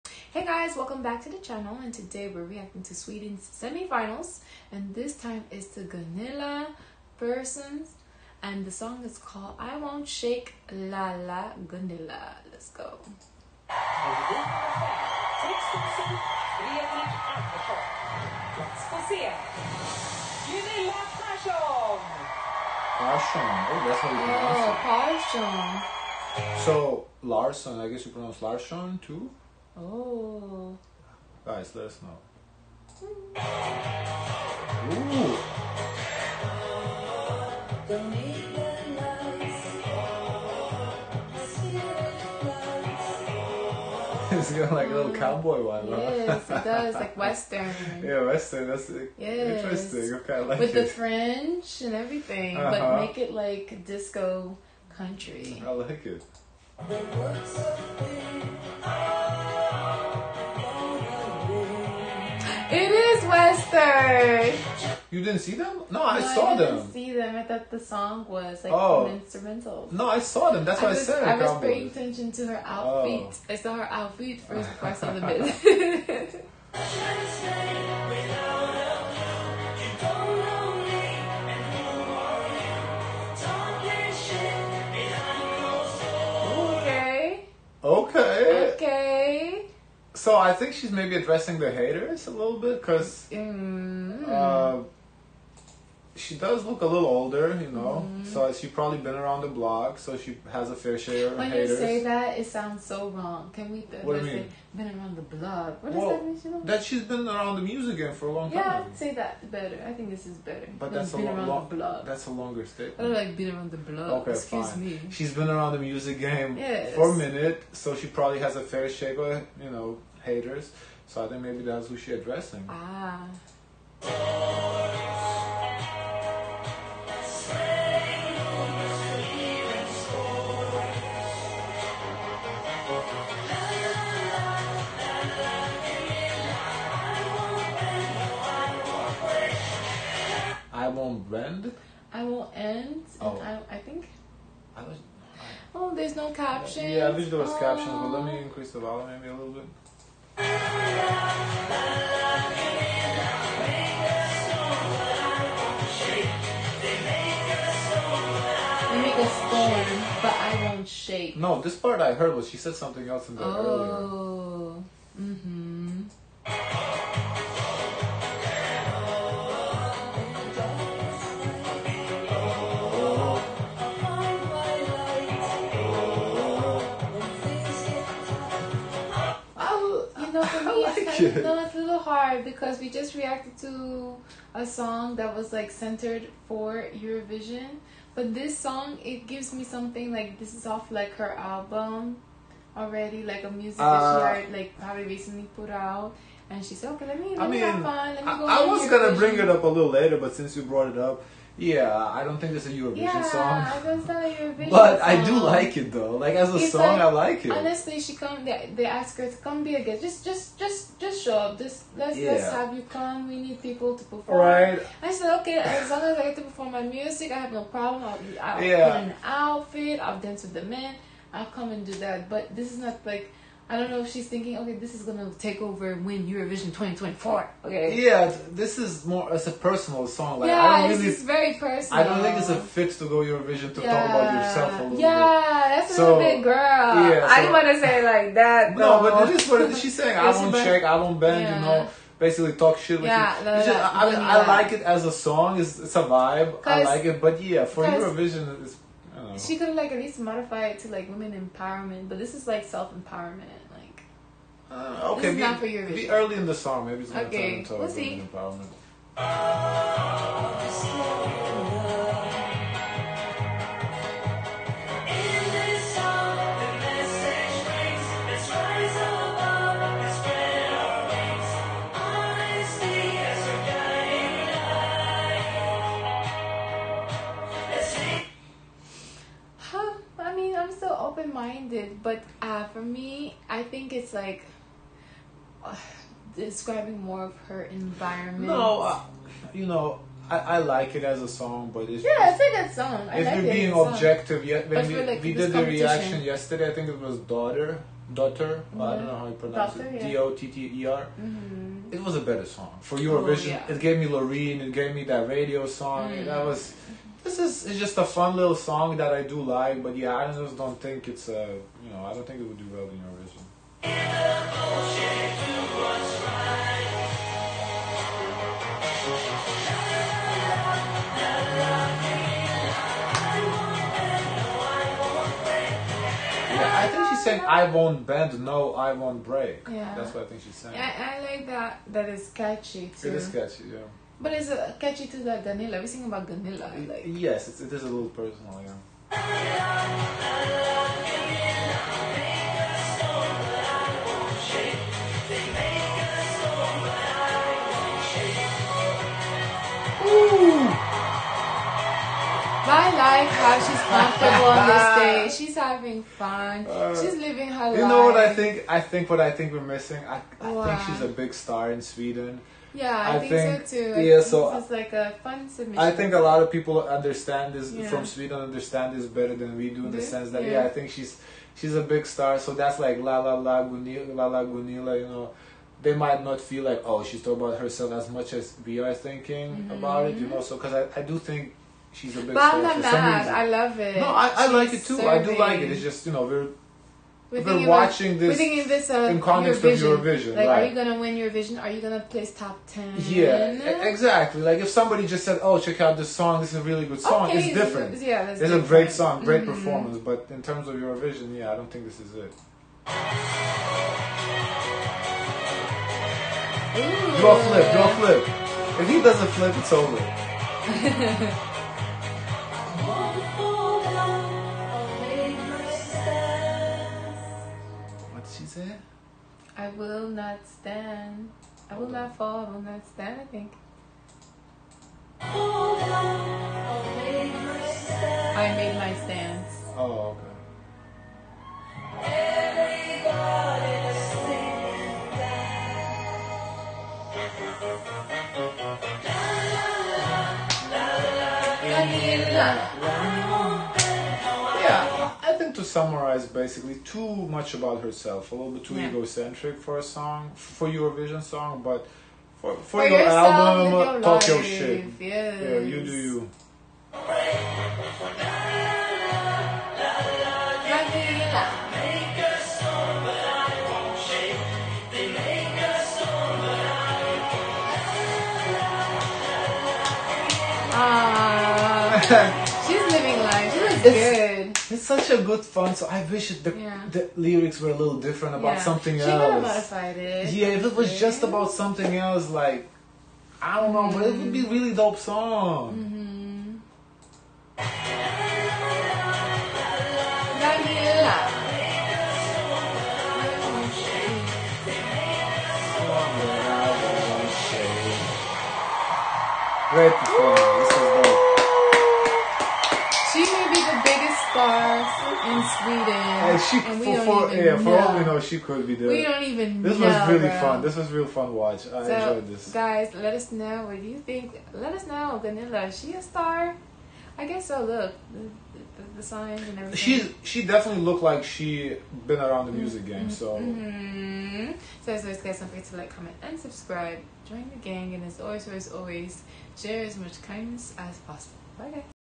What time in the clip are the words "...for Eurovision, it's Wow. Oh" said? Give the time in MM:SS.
04:07.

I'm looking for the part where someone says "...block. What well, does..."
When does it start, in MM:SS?
01:45.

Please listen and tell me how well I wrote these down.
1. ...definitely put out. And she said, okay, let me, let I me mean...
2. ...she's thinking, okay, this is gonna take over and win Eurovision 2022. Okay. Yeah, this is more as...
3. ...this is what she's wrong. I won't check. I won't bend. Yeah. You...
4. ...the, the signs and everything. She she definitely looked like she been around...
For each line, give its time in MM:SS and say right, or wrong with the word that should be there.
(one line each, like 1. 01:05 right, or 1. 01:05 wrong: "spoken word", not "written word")
1. 03:15 wrong: "recently", not "definitely"
2. 03:44 wrong: "2024", not "2022"
3. 03:59 wrong: "saying", not "wrong"
4. 08:38 right.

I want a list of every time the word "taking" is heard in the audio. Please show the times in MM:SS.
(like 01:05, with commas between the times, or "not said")
not said.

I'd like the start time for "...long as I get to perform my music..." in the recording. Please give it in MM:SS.
03:35.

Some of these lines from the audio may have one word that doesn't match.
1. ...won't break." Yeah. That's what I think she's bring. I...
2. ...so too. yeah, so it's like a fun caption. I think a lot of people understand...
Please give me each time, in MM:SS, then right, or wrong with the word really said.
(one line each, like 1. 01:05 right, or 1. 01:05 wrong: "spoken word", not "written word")
1. 05:28 wrong: "saying", not "bring"
2. 06:03 wrong: "submission", not "caption".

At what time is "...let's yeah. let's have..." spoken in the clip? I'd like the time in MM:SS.
03:31.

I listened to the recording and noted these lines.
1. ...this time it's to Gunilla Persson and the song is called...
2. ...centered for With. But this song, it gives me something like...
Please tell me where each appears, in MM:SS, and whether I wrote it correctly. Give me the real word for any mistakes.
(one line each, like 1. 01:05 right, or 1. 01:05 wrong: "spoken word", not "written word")
1. 00:04 right
2. 03:05 wrong: "Eurovision", not "With".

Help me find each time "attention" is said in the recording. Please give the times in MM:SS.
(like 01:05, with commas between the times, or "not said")
01:11.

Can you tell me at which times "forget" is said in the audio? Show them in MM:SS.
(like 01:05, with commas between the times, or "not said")
08:45.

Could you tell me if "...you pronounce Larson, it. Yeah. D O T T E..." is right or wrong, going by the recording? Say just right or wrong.
wrong.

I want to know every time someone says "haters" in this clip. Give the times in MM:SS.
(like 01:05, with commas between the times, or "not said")
01:31, 01:41, 02:00.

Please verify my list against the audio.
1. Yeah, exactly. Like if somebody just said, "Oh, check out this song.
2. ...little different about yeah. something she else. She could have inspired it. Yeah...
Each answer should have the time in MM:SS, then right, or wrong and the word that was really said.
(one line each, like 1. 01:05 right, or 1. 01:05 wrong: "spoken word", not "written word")
1. 06:32 right
2. 07:57 wrong: "modified", not "inspired".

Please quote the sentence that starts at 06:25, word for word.
It's just you know we're we're, we're watching about, this.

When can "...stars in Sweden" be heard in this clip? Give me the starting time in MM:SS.
08:24.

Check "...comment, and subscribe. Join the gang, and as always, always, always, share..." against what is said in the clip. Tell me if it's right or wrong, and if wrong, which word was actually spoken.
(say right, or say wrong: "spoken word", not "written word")
right.